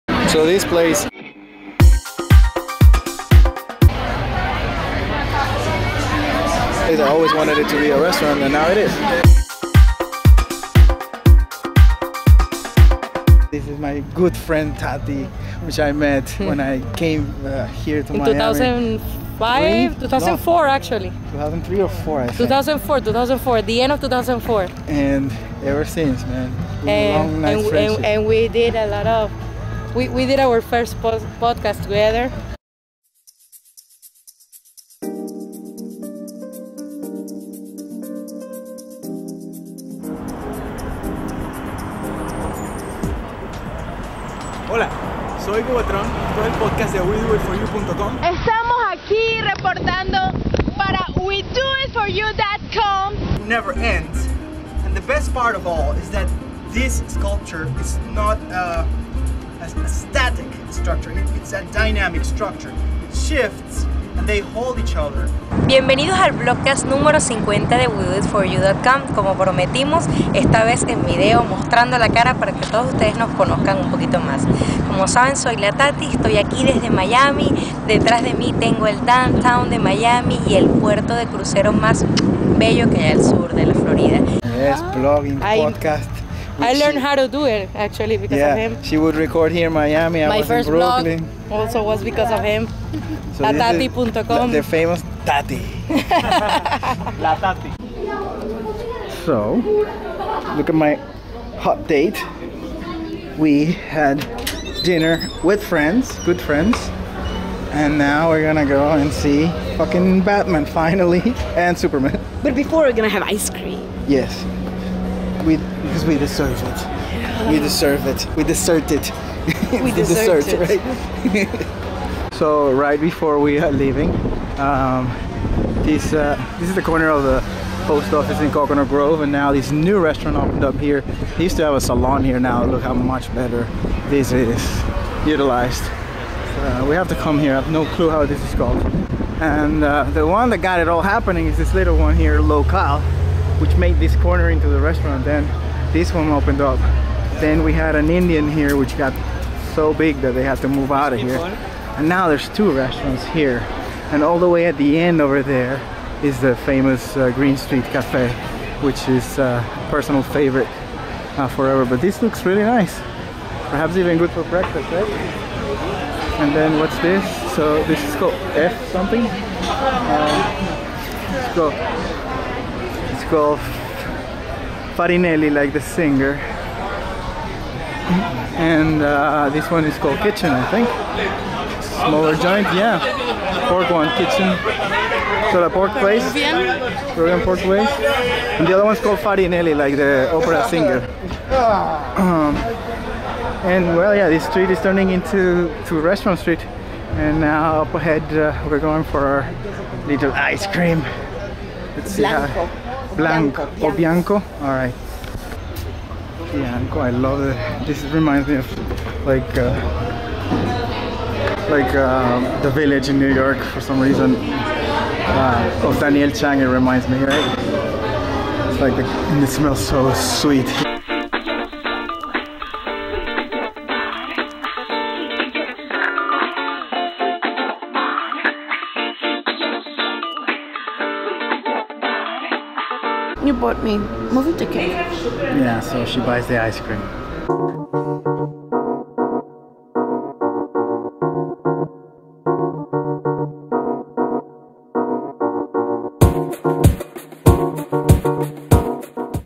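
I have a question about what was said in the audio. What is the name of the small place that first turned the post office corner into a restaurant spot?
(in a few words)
Local.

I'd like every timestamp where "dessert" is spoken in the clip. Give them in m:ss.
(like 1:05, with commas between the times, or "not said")
2:00.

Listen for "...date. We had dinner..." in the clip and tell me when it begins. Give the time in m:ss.
1:41.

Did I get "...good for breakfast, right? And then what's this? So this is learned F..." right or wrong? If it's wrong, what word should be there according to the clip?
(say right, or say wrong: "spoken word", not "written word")
wrong: "called", not "learned".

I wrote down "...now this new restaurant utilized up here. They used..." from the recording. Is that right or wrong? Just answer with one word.
wrong.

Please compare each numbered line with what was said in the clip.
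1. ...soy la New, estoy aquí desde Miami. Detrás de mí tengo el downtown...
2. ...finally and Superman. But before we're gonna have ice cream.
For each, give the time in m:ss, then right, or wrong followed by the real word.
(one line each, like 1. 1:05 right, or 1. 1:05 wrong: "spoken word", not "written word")
1. 1:15 wrong: "Tati", not "New"
2. 1:50 right.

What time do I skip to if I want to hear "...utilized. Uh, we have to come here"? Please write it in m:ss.
2:15.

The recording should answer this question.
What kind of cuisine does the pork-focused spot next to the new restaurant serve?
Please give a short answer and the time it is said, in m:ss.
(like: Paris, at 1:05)
Peruvian, at 3:07.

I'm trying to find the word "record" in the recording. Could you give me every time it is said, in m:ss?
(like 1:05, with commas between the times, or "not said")
1:29.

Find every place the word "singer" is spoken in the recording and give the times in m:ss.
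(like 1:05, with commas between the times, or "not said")
2:55, 3:10.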